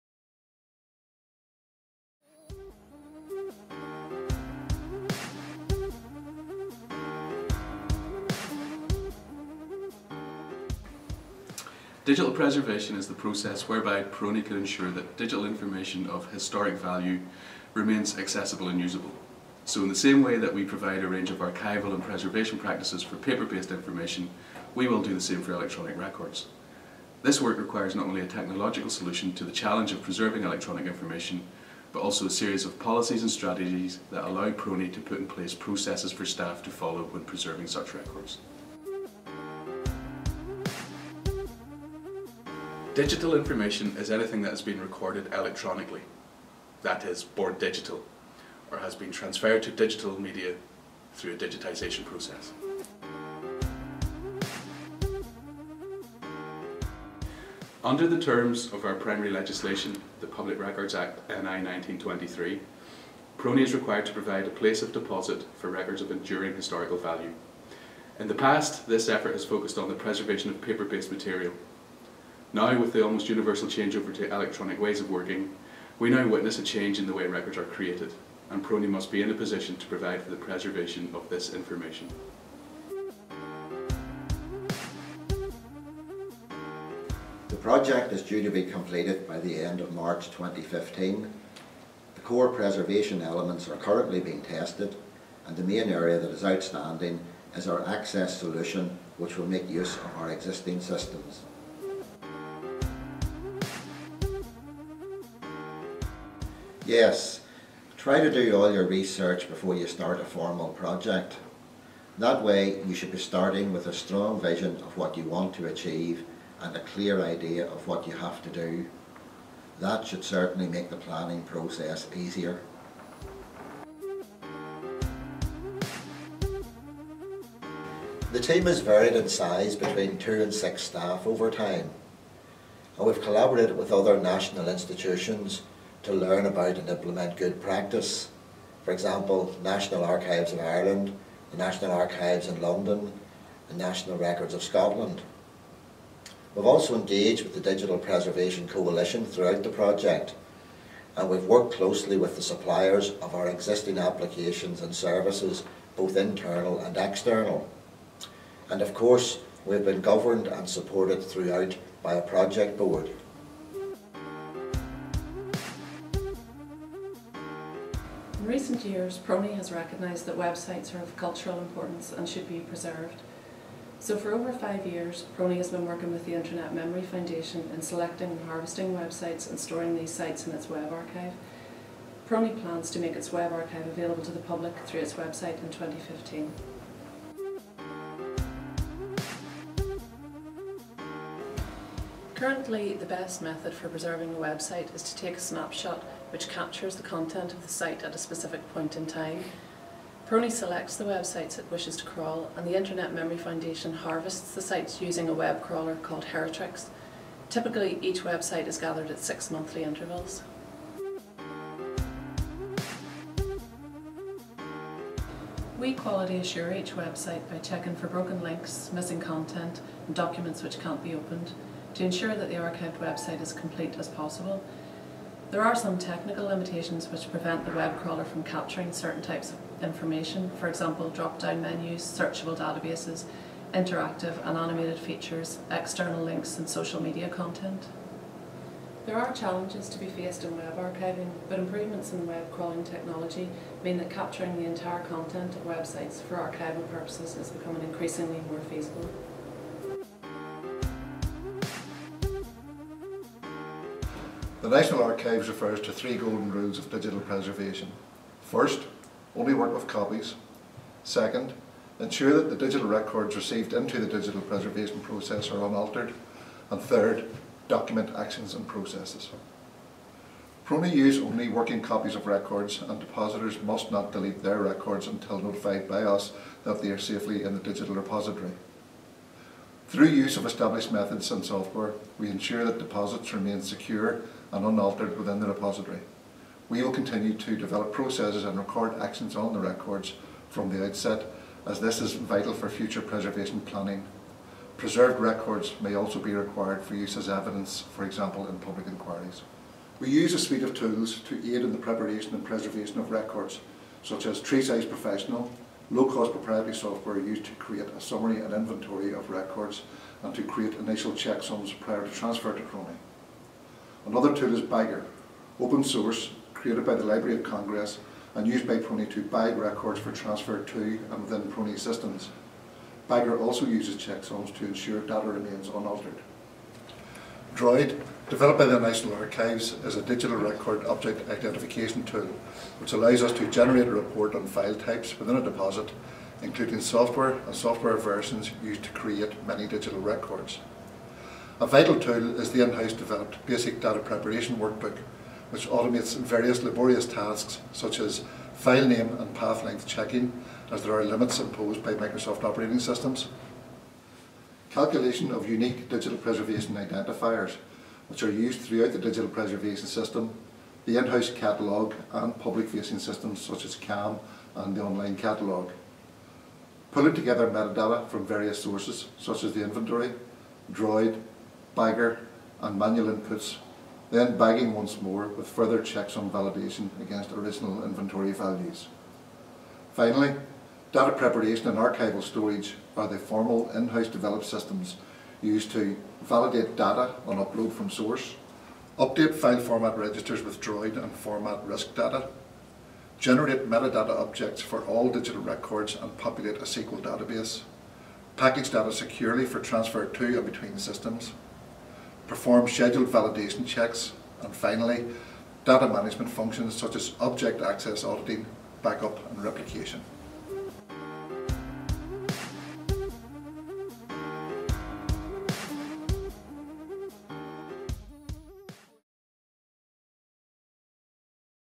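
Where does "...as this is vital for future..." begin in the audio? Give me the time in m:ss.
4:51.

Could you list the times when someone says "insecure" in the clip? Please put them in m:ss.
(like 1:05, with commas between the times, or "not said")
not said.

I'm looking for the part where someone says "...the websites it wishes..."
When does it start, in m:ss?
3:20.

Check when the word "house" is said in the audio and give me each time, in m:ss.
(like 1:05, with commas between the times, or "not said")
5:42, 6:00, 6:23.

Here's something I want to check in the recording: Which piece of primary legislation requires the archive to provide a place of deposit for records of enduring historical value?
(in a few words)
Public Records Act NI 1923.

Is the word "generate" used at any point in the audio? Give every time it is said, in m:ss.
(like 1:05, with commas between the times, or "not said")
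5:33, 6:33.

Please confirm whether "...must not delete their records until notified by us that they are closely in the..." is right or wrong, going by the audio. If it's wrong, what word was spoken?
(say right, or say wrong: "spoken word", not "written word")
wrong: "safely", not "closely".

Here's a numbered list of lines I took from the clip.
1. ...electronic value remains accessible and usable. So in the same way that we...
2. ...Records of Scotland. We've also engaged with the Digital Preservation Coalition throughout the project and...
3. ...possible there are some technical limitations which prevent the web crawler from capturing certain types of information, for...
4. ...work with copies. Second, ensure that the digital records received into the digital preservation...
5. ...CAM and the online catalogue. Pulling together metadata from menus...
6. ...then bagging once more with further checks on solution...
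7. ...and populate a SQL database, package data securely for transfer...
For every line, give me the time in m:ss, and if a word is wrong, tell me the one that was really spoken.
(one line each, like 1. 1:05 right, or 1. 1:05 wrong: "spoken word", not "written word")
1. 0:16 wrong: "historic", not "electronic"
2. 2:24 right
3. 3:44 right
4. 4:19 right
5. 6:03 wrong: "various", not "menus"
6. 6:14 wrong: "validation", not "solution"
7. 6:35 right.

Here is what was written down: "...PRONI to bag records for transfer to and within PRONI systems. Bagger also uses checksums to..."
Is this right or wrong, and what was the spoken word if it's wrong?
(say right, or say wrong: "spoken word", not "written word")
right.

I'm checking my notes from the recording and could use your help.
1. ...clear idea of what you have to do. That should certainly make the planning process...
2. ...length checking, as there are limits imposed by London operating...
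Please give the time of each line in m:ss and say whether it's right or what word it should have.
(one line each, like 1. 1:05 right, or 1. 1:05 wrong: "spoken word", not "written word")
1. 1:56 right
2. 5:49 wrong: "Microsoft", not "London".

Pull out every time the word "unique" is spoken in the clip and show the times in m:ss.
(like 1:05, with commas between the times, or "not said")
5:55.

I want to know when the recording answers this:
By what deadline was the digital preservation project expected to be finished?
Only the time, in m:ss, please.
1:29.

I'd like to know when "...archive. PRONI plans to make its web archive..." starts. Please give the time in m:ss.
3:00.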